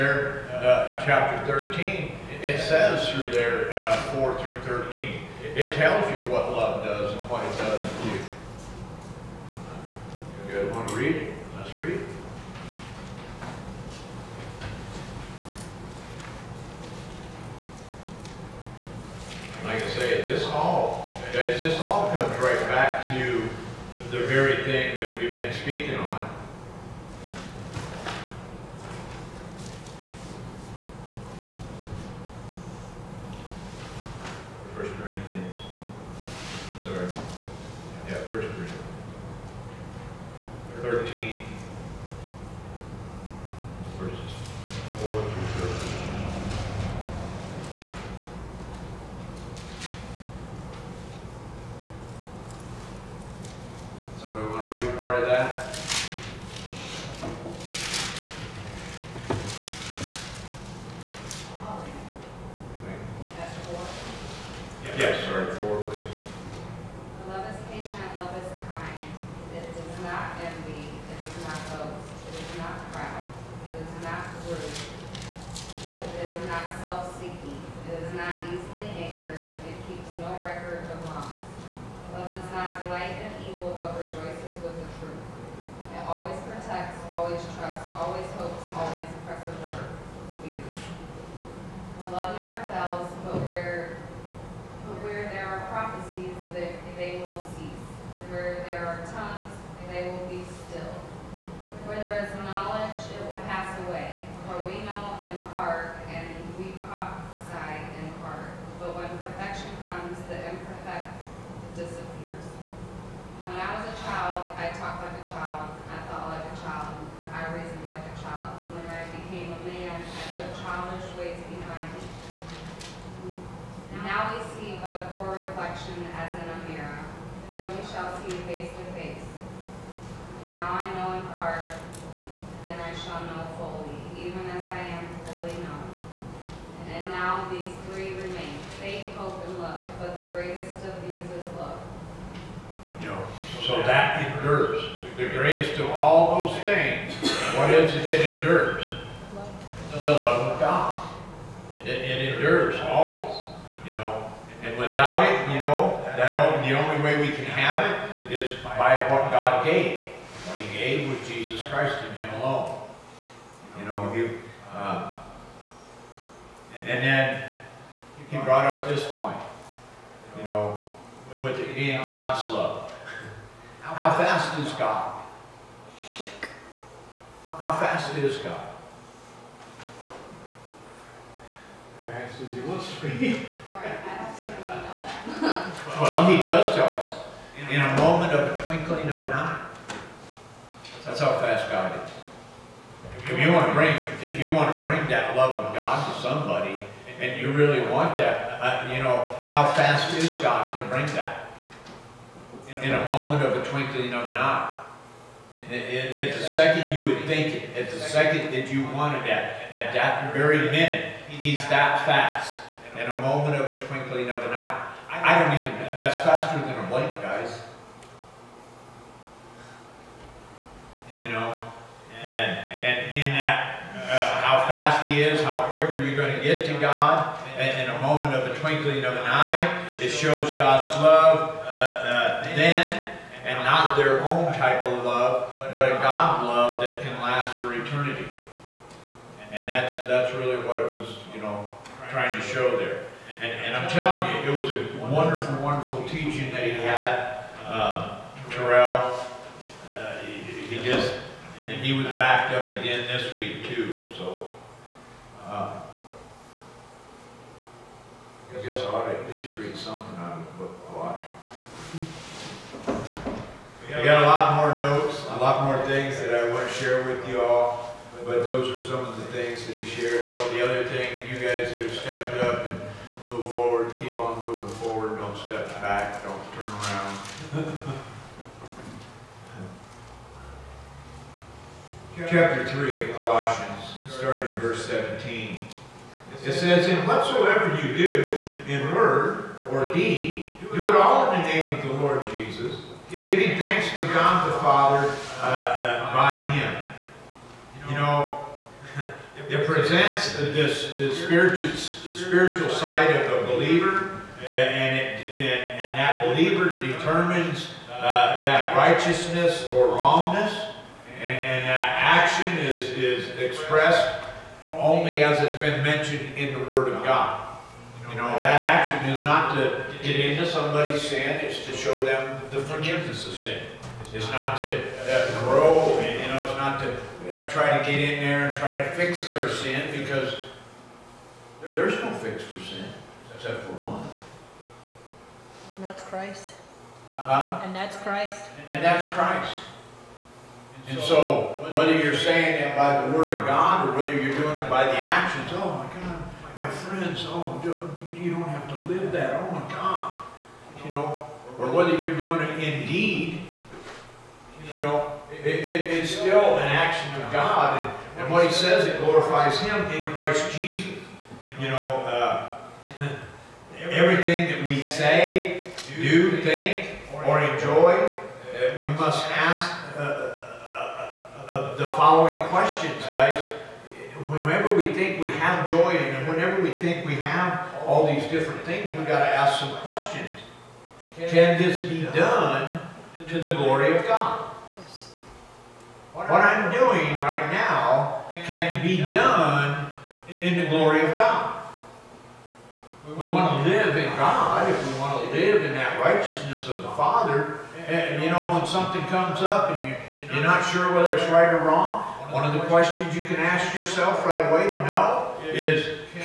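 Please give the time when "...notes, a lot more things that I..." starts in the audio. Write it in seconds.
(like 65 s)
264 s.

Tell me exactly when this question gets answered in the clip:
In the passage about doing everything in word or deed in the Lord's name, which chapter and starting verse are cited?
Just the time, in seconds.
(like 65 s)
282 s.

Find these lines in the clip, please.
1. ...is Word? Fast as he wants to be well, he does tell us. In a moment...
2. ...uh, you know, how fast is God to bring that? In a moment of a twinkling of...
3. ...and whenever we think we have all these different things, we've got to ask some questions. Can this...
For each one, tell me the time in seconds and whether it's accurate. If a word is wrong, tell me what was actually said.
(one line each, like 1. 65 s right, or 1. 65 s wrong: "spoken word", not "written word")
1. 178 s wrong: "God", not "Word"
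2. 198 s right
3. 375 s right.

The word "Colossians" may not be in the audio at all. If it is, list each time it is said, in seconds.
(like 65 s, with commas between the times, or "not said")
260 s, 283 s.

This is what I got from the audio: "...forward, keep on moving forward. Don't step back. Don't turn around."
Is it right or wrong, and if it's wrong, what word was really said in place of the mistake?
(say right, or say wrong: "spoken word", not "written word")
right.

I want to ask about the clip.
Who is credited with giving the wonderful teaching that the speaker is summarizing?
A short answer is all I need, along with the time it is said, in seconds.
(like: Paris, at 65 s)
Terrell, at 248 s.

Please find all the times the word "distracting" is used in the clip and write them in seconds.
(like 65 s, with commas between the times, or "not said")
not said.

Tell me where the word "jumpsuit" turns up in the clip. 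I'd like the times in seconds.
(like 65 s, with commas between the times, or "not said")
not said.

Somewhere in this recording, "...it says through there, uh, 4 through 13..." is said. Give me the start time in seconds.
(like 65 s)
2 s.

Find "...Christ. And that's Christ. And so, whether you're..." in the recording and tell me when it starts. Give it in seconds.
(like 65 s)
337 s.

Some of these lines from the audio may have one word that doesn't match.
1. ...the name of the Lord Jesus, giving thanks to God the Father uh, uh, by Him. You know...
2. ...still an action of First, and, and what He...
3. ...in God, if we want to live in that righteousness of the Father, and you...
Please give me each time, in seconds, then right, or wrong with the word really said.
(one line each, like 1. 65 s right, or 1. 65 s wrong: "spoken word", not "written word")
1. 291 s right
2. 356 s wrong: "God", not "First"
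3. 393 s right.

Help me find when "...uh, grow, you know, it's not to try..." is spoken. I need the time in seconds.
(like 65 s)
324 s.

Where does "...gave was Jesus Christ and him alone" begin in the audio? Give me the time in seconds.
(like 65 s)
160 s.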